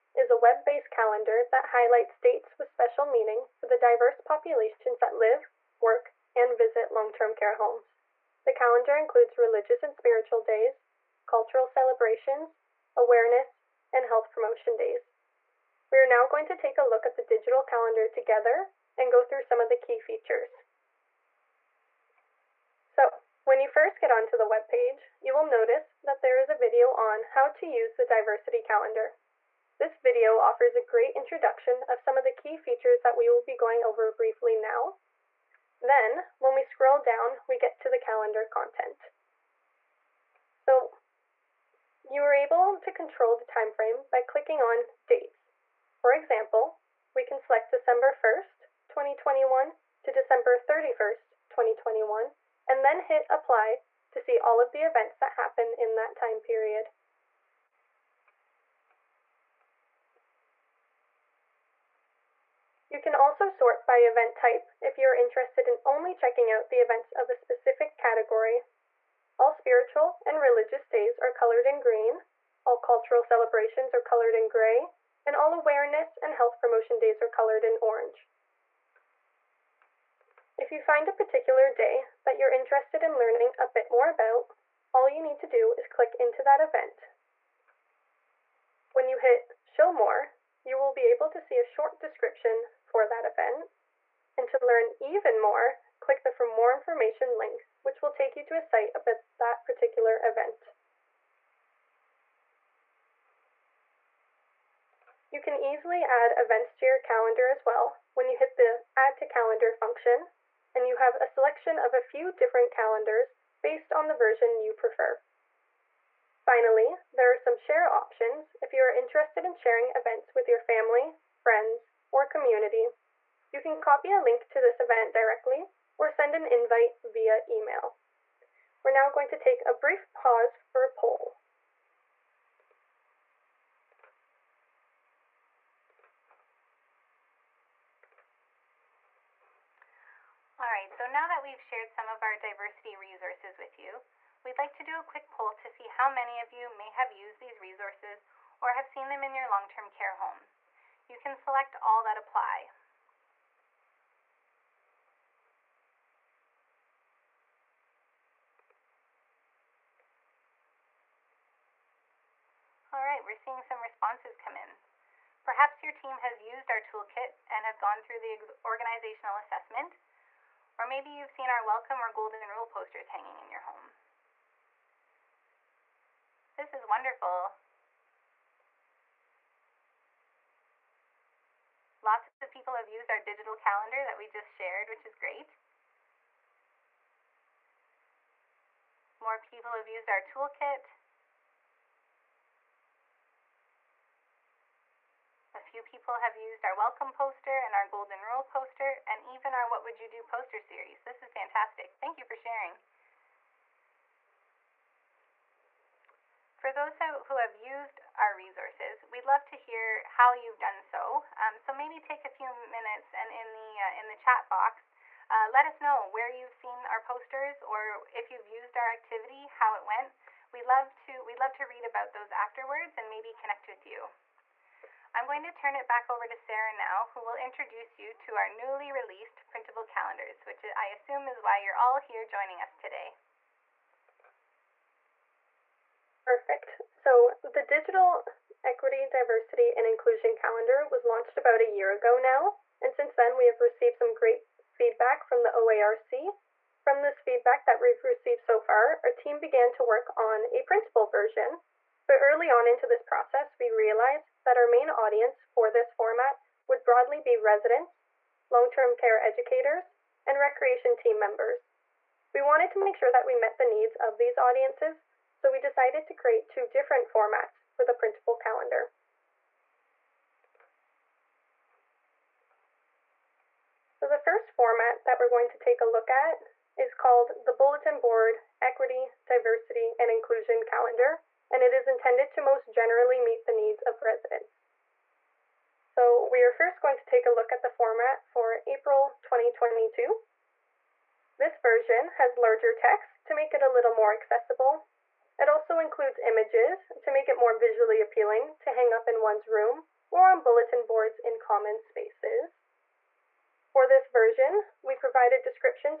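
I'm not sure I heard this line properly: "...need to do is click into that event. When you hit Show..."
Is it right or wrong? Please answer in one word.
right.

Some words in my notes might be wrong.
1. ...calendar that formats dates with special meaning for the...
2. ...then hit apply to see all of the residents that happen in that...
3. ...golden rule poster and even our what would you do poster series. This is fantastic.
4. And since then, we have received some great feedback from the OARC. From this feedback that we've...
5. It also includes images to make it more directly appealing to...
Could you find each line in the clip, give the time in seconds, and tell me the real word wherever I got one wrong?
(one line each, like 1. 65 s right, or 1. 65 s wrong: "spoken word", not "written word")
1. 0 s wrong: "highlights", not "formats"
2. 52 s wrong: "events", not "residents"
3. 197 s right
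4. 242 s right
5. 295 s wrong: "visually", not "directly".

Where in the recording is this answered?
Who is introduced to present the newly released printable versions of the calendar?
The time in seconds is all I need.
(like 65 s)
226 s.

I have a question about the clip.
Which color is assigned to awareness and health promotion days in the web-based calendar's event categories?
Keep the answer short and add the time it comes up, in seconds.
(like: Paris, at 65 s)
Orange, at 77 s.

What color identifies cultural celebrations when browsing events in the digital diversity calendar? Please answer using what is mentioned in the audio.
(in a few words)
Gray.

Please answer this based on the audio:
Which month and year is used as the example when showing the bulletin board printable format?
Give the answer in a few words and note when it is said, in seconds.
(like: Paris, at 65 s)
April 2022, at 288 s.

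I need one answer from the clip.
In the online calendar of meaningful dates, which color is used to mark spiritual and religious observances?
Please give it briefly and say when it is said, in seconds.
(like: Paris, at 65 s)
Green, at 71 s.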